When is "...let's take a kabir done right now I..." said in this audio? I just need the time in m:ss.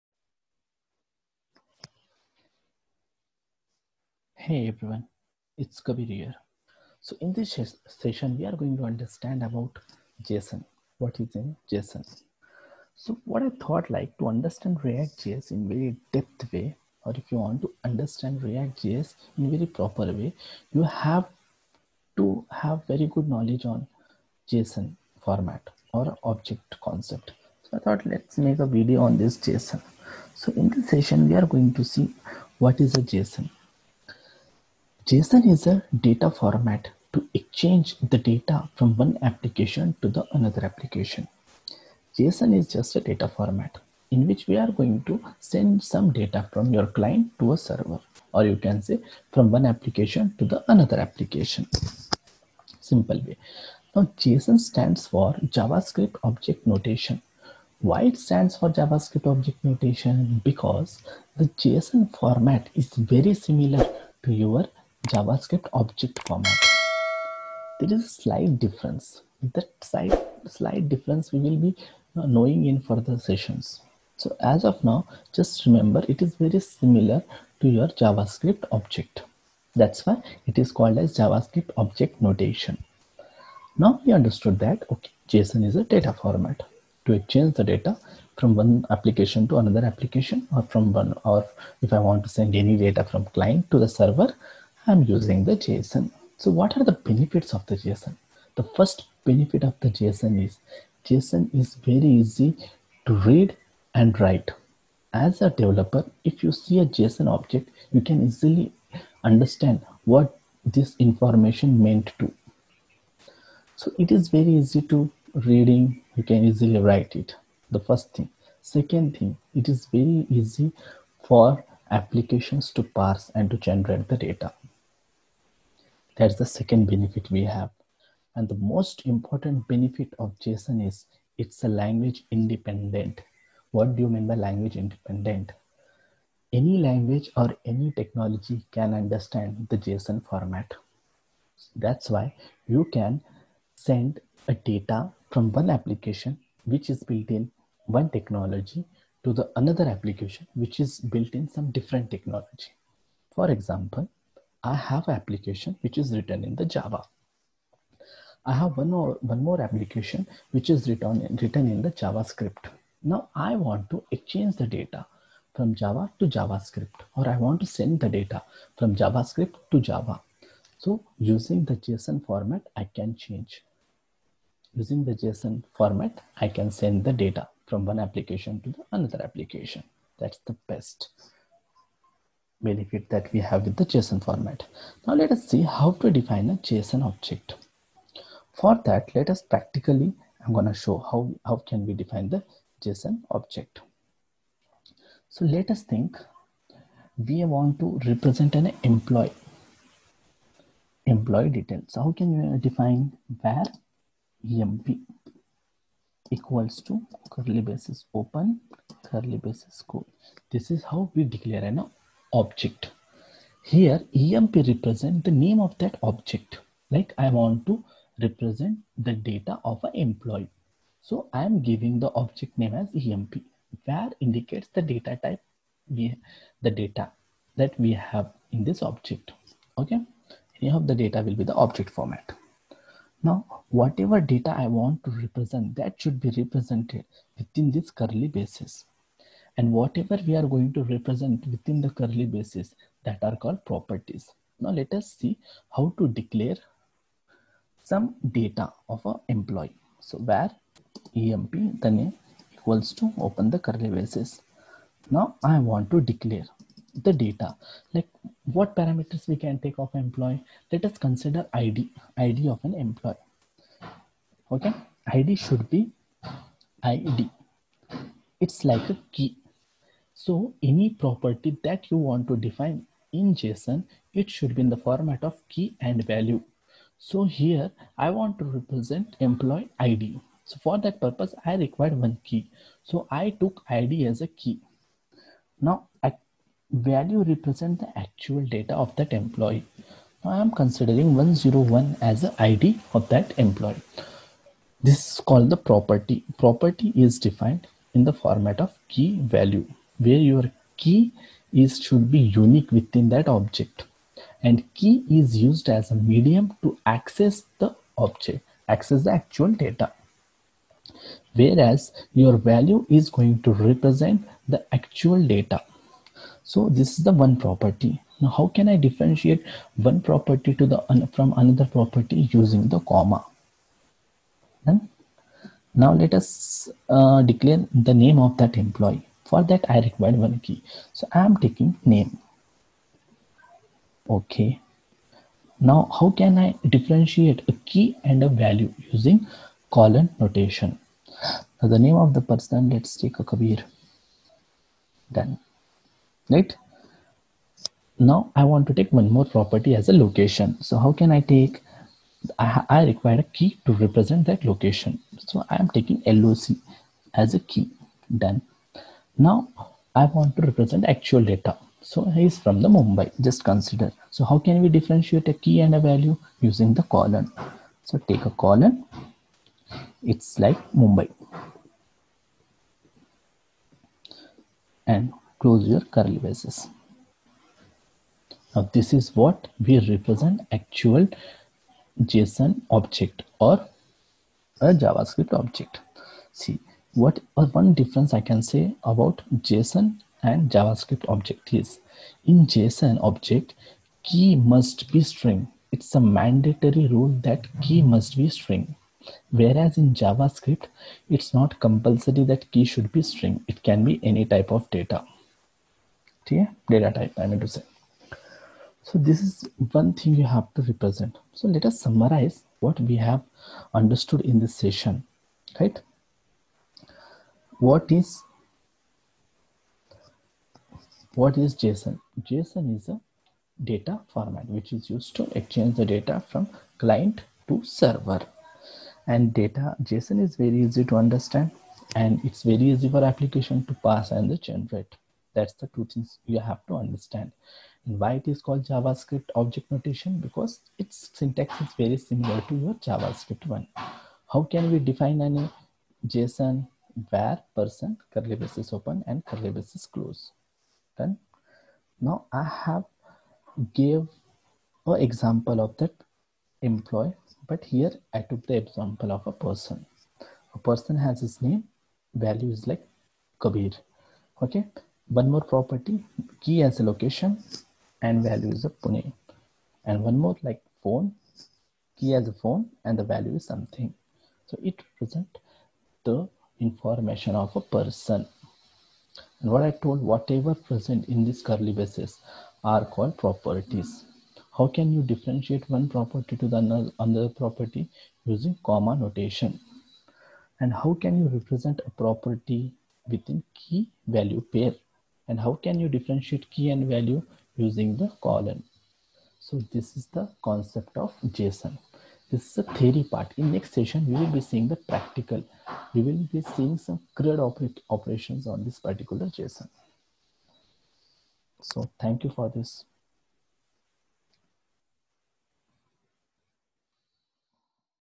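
5:42.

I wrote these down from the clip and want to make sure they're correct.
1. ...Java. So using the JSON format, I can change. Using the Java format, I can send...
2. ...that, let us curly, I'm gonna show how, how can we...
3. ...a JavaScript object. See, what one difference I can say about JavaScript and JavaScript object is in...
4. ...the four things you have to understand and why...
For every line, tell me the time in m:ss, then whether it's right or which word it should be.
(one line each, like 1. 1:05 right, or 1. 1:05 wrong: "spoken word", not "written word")
1. 2:49 wrong: "JSON", not "Java"
2. 3:08 wrong: "practically", not "curly"
3. 6:24 wrong: "JSON", not "JavaScript"
4. 7:15 wrong: "two", not "four".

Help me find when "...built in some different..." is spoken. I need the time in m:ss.
2:30.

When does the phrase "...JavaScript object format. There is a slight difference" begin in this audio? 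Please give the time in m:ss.
1:05.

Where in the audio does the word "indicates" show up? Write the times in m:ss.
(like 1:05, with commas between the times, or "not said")
3:44.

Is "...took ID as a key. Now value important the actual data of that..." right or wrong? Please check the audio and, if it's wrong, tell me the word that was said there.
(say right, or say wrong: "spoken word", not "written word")
wrong: "represent", not "important".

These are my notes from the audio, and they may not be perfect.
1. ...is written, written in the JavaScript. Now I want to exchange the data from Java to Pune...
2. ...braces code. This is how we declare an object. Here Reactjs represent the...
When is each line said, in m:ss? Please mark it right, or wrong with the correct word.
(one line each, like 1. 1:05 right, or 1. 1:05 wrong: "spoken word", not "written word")
1. 2:40 wrong: "JavaScript", not "Pune"
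2. 3:29 wrong: "EMP", not "Reactjs".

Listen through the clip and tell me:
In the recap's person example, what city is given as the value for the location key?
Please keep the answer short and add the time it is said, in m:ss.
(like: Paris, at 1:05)
Pune, at 7:48.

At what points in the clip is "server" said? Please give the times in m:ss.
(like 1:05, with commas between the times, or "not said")
0:47, 1:33, 7:07.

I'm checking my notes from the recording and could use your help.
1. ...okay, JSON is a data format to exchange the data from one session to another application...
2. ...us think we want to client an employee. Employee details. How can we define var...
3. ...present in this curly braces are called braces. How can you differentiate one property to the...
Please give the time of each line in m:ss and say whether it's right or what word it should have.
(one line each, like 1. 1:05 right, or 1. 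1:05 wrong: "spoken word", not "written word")
1. 1:24 wrong: "application", not "session"
2. 3:15 wrong: "represent", not "client"
3. 8:00 wrong: "properties", not "braces".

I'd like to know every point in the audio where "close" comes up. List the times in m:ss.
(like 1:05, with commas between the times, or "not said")
6:15, 7:29.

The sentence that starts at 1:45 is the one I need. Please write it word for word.
As a developer, if you see a JSON object, you can easily understand what this information meant to.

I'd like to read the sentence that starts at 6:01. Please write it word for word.
So he is from the Mumbai, just consider.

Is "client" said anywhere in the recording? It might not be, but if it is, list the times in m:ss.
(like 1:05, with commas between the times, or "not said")
0:46, 1:33, 7:06.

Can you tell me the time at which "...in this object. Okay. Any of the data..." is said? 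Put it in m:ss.
3:48.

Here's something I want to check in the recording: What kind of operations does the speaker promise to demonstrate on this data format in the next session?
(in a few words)
CRUD operations.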